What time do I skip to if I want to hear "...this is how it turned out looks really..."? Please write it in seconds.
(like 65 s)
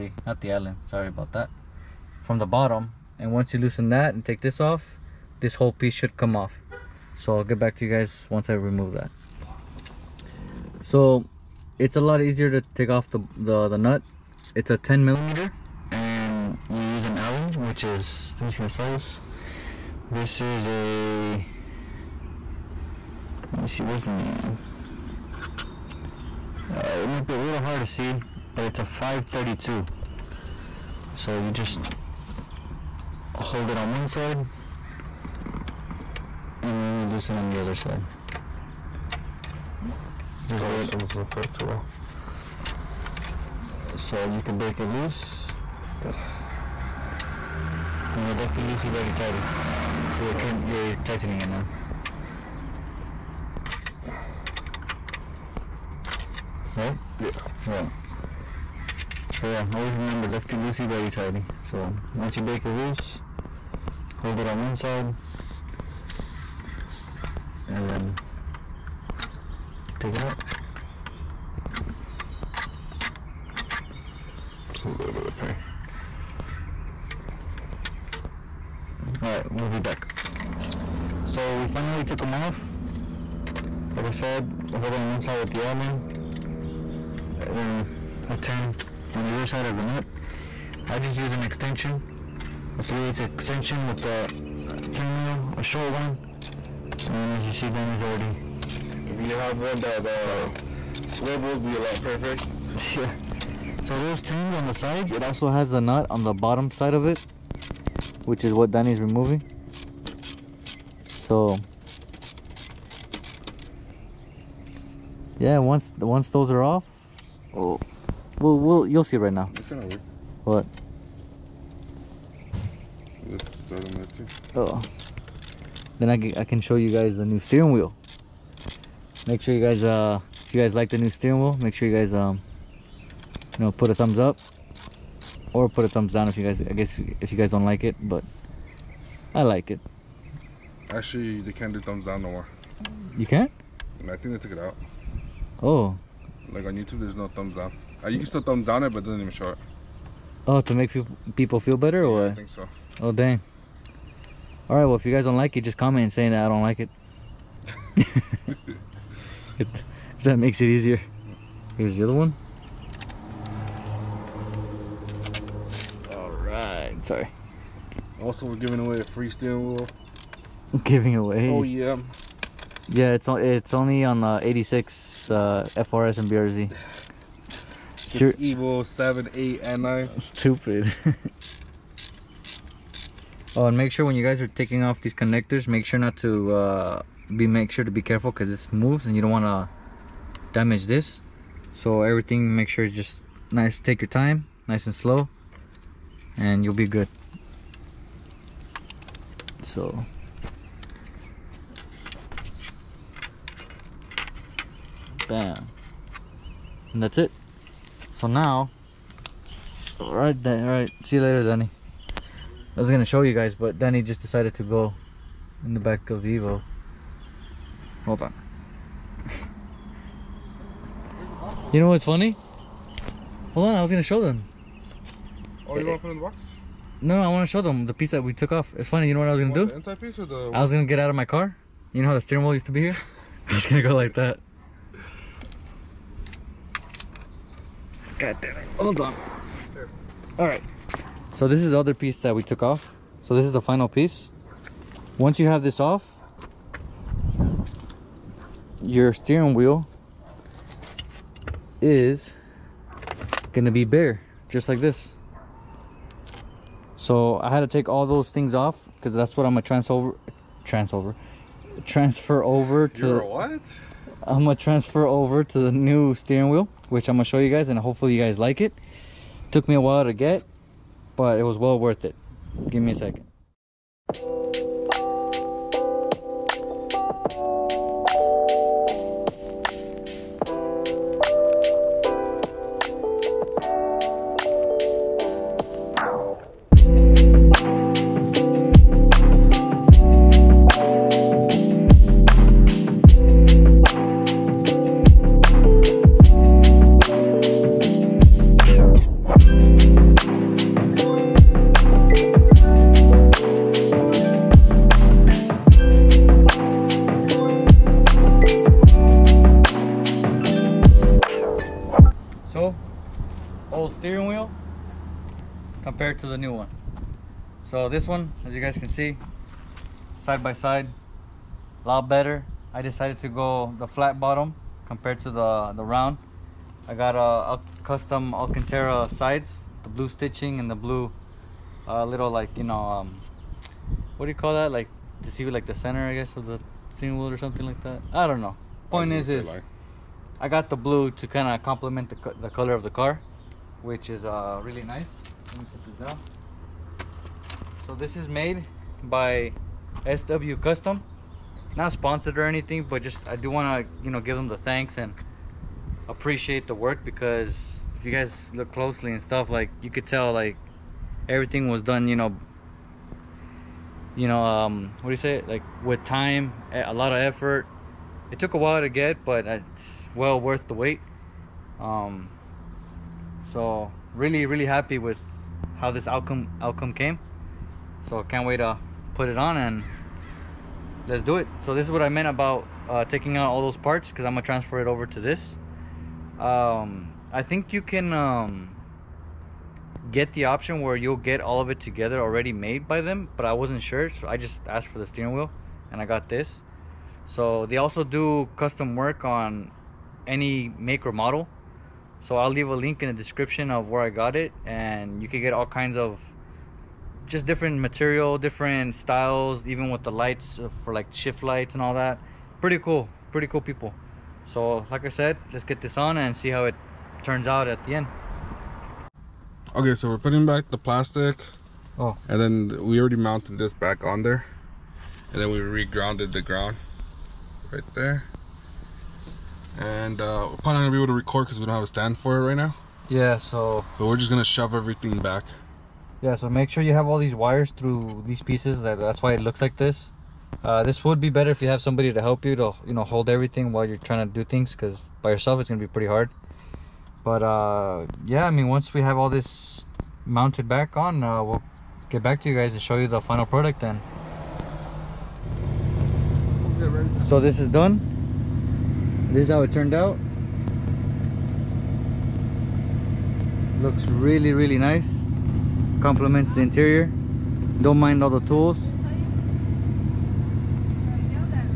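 459 s.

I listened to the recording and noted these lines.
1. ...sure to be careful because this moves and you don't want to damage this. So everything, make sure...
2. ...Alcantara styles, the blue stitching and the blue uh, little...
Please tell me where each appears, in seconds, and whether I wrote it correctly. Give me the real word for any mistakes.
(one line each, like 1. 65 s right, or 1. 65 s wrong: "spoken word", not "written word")
1. 187 s right
2. 328 s wrong: "sides", not "styles".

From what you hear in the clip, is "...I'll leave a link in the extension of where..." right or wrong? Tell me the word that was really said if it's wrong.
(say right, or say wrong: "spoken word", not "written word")
wrong: "description", not "extension".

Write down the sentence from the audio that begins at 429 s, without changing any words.
And uh, we're probably not gonna be able to record because we don't have a stand for it right now.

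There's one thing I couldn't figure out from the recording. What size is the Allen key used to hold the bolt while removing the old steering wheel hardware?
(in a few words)
5/32.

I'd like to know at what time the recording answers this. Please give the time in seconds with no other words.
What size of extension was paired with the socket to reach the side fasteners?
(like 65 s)
92 s.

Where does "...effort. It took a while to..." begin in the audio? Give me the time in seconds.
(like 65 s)
367 s.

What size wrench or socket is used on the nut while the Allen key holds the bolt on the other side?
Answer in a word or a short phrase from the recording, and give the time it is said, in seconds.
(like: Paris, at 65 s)
10 millimeter, at 14 s.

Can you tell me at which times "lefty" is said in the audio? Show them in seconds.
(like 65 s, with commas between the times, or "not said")
48 s, 60 s.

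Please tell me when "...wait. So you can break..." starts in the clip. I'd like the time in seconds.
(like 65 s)
40 s.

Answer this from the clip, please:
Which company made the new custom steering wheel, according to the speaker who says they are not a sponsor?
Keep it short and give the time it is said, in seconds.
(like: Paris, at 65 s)
SW Custom, at 350 s.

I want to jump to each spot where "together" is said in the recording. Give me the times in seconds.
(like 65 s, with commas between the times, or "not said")
391 s.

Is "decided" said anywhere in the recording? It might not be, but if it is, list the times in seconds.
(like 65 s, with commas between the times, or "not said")
214 s, 322 s.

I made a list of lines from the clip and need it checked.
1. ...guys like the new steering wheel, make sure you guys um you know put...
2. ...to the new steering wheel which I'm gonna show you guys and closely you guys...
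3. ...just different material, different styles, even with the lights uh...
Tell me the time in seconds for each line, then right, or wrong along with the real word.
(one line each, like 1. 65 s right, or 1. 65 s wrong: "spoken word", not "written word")
1. 130 s right
2. 265 s wrong: "hopefully", not "closely"
3. 407 s right.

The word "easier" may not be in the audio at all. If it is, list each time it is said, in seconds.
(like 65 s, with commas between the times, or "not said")
12 s, 160 s.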